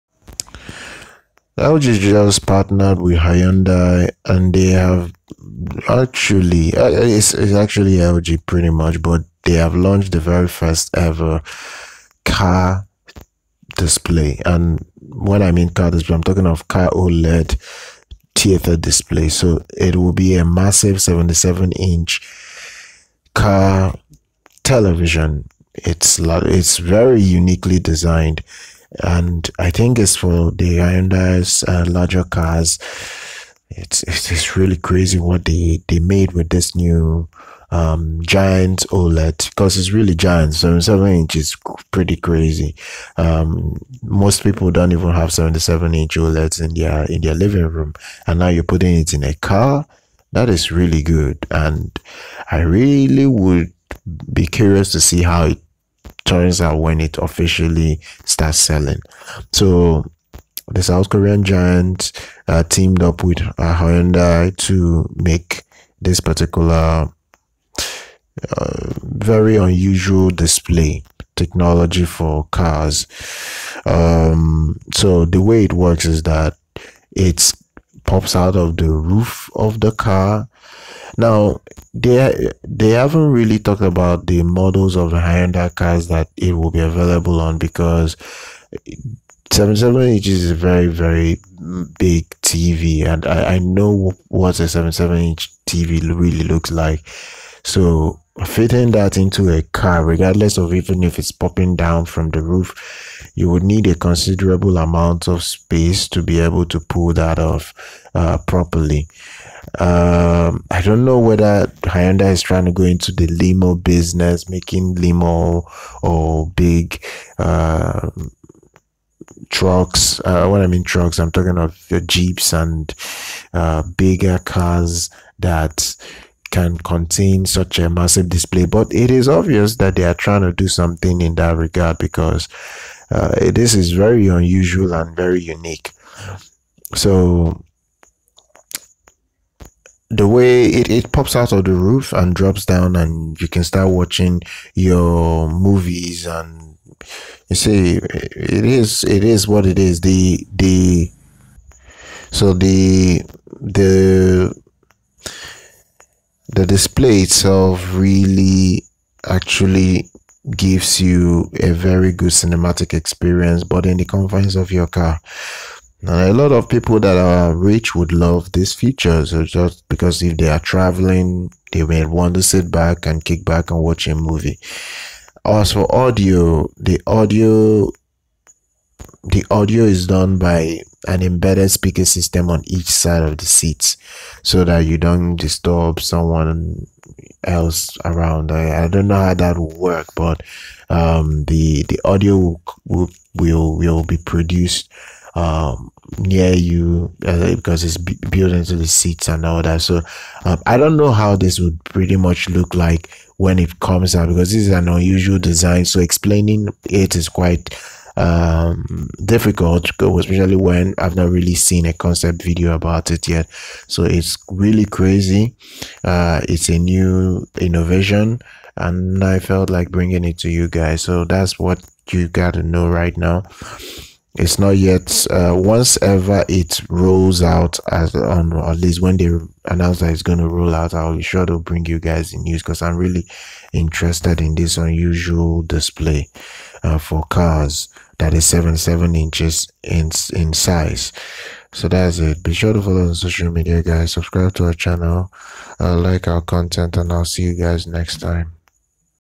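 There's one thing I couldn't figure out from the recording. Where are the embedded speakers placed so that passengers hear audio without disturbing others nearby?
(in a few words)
Each side of the seats.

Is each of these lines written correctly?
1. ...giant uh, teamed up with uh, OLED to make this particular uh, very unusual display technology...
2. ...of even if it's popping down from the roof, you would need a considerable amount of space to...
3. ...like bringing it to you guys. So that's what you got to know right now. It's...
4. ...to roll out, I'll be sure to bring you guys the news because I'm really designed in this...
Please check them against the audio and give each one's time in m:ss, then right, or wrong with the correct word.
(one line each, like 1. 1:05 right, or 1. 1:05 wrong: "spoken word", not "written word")
1. 1:01 wrong: "Hyundai", not "OLED"
2. 1:40 right
3. 3:39 right
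4. 3:50 wrong: "interested", not "designed".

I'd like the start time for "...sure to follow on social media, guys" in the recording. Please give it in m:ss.
4:02.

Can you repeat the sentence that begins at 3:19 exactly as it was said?
So um, I don't know how this would pretty much look like when it comes out because this is an unusual design.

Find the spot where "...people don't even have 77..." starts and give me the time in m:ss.
0:44.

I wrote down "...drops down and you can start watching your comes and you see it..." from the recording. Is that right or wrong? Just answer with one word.
wrong.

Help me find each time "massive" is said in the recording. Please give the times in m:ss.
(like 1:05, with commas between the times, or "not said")
0:20, 2:07.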